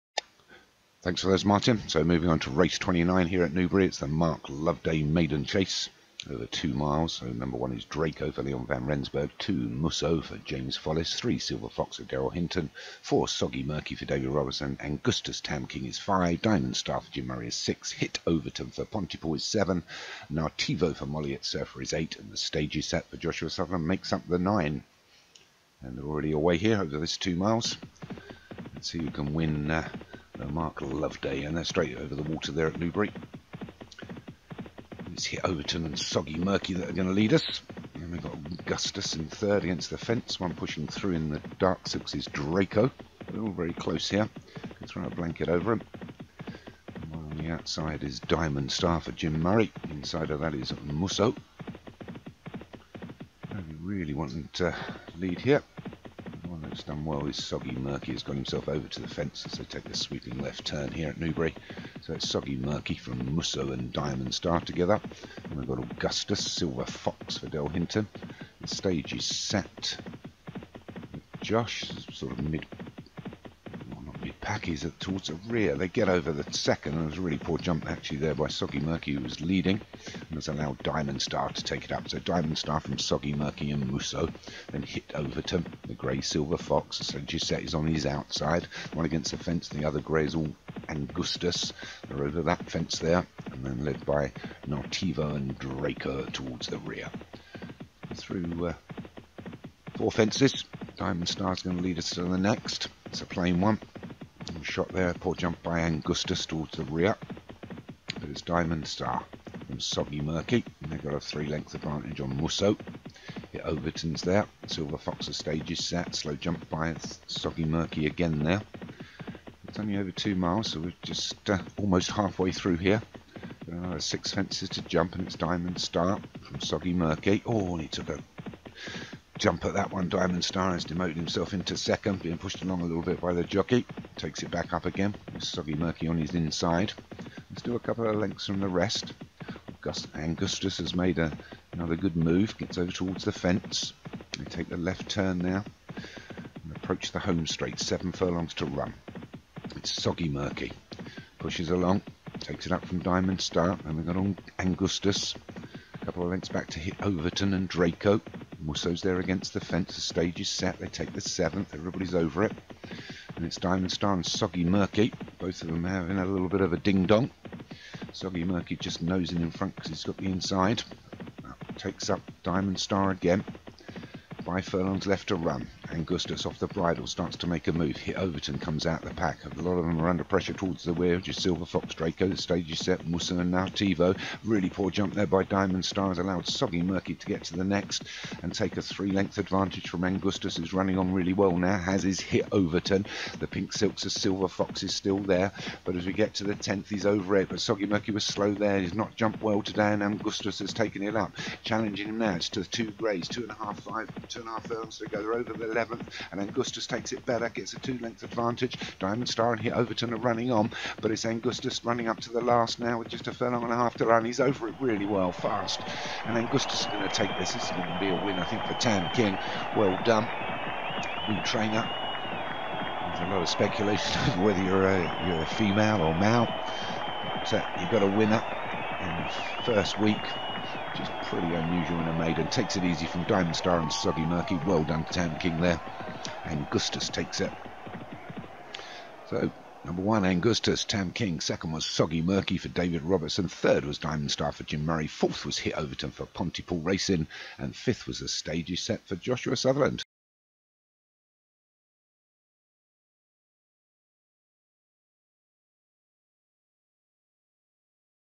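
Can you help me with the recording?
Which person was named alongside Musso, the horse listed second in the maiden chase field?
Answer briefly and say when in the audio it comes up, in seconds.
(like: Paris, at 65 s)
James Follis, at 10 s.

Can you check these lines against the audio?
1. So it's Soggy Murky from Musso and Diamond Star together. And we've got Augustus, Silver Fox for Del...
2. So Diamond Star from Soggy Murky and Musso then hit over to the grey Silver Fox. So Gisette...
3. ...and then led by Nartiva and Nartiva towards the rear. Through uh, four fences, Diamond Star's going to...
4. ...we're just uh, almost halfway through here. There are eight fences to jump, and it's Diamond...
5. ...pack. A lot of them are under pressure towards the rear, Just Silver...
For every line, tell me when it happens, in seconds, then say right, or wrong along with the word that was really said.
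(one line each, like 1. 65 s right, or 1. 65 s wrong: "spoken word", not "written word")
1. 62 s right
2. 82 s right
3. 93 s wrong: "Draco", not "Nartiva"
4. 120 s wrong: "six", not "eight"
5. 179 s right.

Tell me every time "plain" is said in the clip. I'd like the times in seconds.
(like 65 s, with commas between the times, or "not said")
103 s.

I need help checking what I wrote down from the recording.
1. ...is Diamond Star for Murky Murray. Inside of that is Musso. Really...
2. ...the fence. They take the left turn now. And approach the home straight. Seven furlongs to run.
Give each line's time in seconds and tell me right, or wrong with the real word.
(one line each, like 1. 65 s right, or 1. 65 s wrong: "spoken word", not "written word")
1. 48 s wrong: "Jim", not "Murky"
2. 143 s right.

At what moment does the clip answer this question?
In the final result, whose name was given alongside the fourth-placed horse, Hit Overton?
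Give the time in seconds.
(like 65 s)
246 s.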